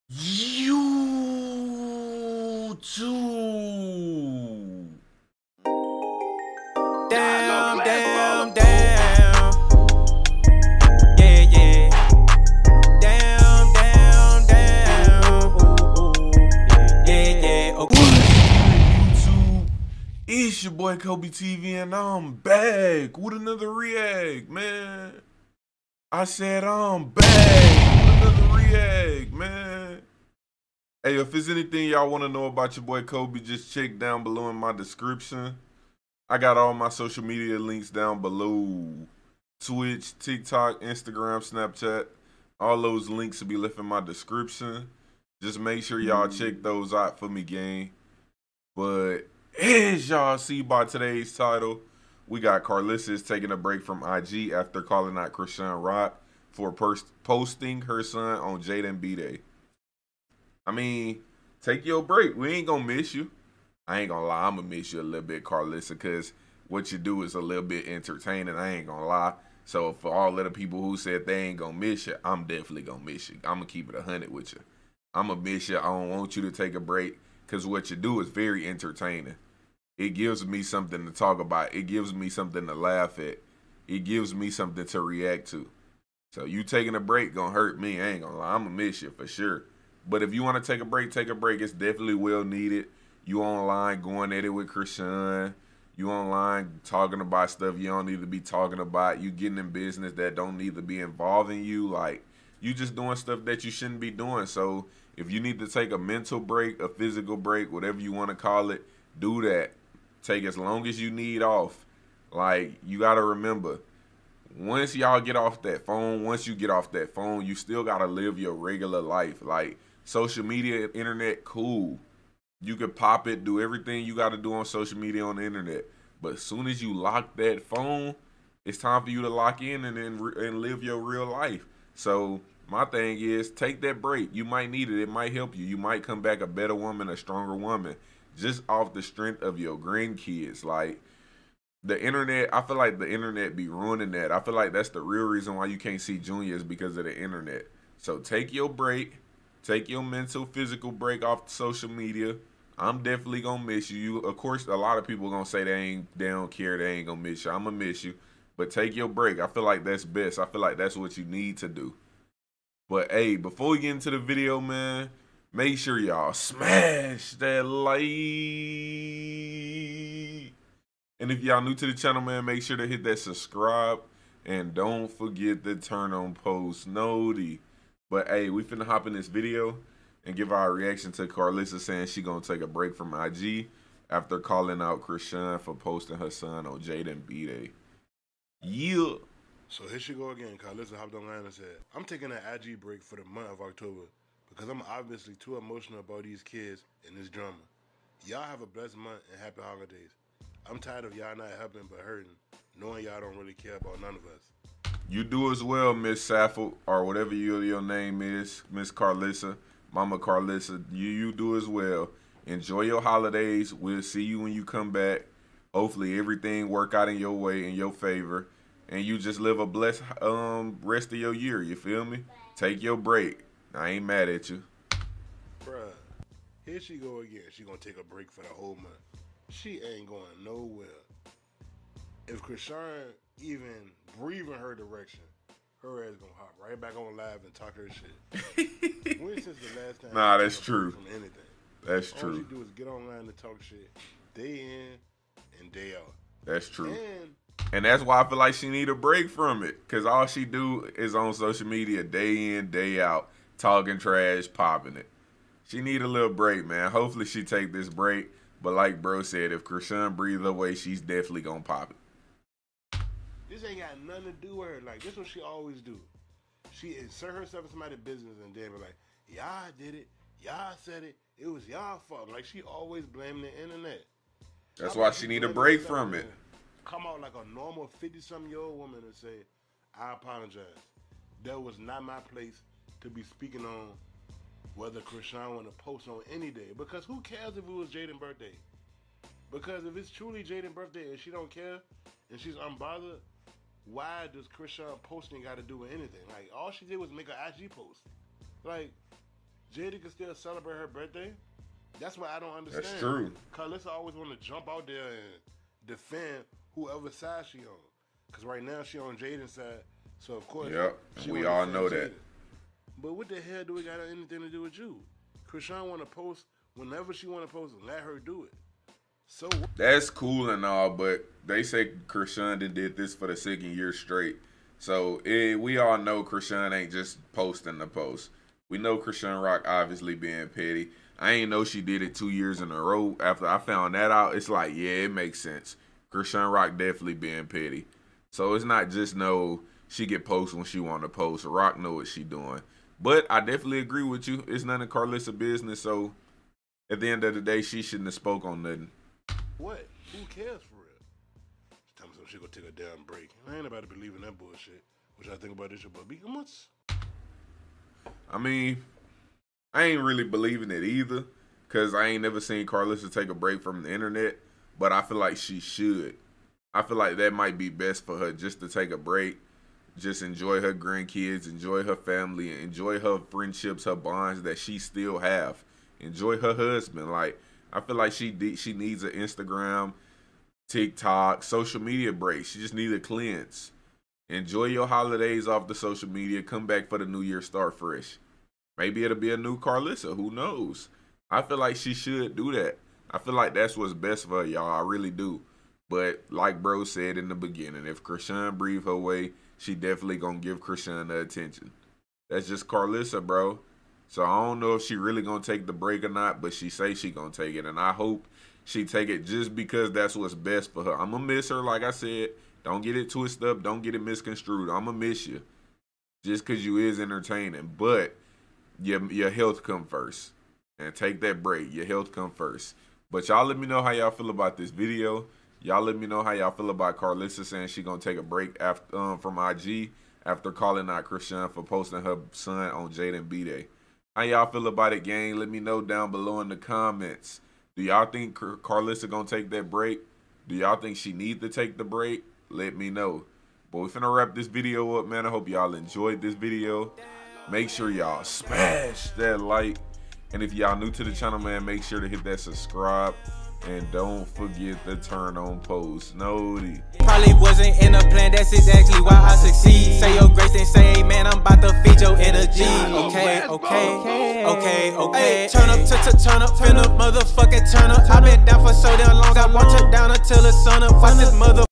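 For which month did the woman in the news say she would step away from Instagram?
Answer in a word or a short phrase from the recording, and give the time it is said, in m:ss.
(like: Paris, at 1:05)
October, at 3:13.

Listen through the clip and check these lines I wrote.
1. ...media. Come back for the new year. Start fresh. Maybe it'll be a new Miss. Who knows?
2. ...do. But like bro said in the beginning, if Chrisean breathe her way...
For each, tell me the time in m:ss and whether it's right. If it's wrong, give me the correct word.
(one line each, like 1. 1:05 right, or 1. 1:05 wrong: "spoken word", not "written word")
1. 6:26 wrong: "Karlissa", not "Miss"
2. 6:35 right.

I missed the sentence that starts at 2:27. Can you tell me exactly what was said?
So take your break Take your mental, physical break off social media.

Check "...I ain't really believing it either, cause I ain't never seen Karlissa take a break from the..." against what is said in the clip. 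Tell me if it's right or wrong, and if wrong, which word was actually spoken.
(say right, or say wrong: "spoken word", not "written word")
right.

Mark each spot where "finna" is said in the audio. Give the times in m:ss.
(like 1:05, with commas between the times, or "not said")
2:58, 7:23.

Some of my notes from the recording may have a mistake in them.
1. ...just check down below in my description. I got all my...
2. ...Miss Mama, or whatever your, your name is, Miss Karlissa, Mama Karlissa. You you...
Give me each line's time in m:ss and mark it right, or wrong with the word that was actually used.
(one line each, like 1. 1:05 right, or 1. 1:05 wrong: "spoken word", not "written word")
1. 0:33 right
2. 3:25 wrong: "Saffold", not "Mama".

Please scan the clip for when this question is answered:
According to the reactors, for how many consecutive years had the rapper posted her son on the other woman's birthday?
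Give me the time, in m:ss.
5:23.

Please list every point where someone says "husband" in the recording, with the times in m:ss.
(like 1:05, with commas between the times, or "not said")
6:16.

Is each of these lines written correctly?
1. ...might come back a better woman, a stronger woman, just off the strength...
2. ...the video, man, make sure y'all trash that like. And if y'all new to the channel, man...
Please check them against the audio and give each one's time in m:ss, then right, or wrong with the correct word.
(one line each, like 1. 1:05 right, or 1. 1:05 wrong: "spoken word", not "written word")
1. 2:15 right
2. 2:44 wrong: "smash", not "trash".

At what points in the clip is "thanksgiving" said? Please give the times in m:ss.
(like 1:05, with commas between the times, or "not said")
not said.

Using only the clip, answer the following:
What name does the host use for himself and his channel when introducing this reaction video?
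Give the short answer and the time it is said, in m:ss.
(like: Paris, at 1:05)
Kobe TV, at 0:20.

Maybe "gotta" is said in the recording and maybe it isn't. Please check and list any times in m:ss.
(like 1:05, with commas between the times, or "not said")
1:52, 1:57.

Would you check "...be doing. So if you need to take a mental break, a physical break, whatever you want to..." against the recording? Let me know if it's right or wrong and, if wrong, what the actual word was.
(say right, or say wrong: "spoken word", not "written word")
right.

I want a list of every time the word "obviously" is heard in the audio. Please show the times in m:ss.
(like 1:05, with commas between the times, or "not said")
3:14, 5:29.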